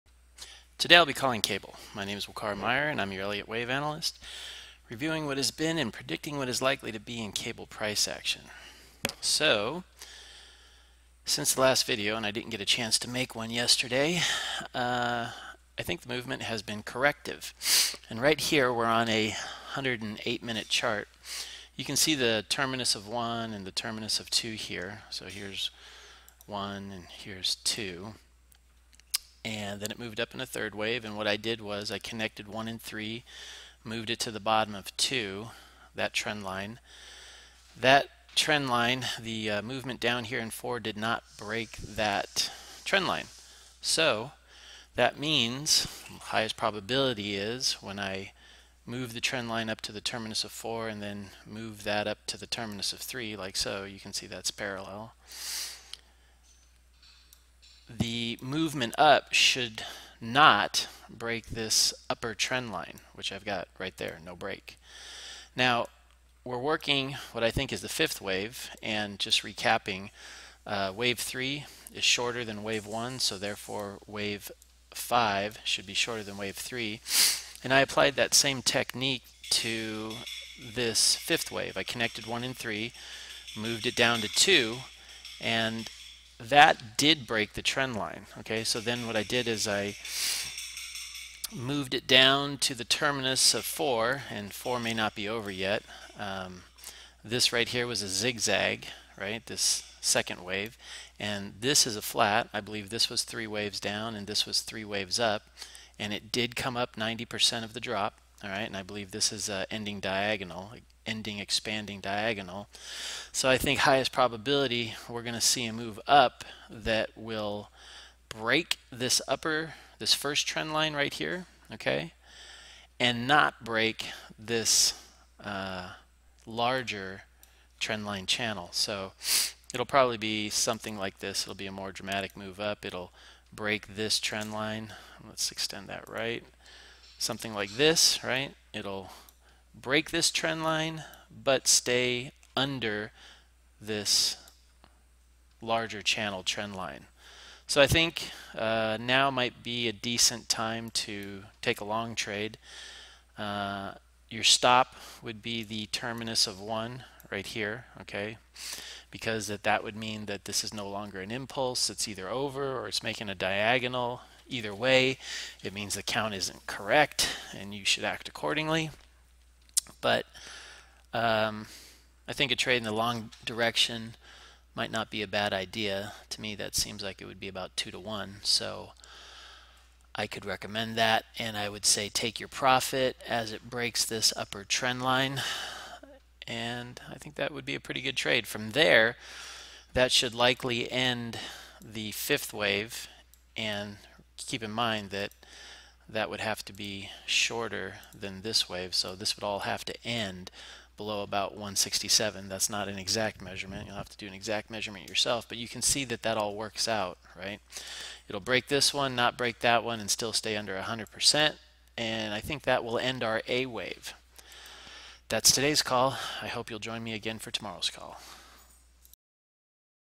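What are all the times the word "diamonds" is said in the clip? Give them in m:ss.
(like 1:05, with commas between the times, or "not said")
not said.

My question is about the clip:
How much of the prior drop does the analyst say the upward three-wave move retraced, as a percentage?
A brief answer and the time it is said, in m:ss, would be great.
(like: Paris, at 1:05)
90%, at 1:46.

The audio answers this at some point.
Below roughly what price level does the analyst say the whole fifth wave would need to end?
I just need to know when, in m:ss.
3:21.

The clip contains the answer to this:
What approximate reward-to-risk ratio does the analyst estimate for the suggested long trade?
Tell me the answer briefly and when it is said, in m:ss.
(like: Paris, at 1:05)
2 to 1, at 2:57.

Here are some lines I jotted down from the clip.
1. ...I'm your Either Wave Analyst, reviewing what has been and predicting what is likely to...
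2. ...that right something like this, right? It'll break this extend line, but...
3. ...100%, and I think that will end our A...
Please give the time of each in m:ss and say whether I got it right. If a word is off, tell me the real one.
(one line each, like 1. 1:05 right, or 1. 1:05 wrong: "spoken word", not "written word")
1. 0:02 wrong: "Elliott", not "Either"
2. 2:15 wrong: "trend", not "extend"
3. 3:30 right.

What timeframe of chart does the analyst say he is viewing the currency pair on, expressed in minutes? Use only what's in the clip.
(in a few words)
108 minute.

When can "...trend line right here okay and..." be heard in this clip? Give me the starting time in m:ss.
2:00.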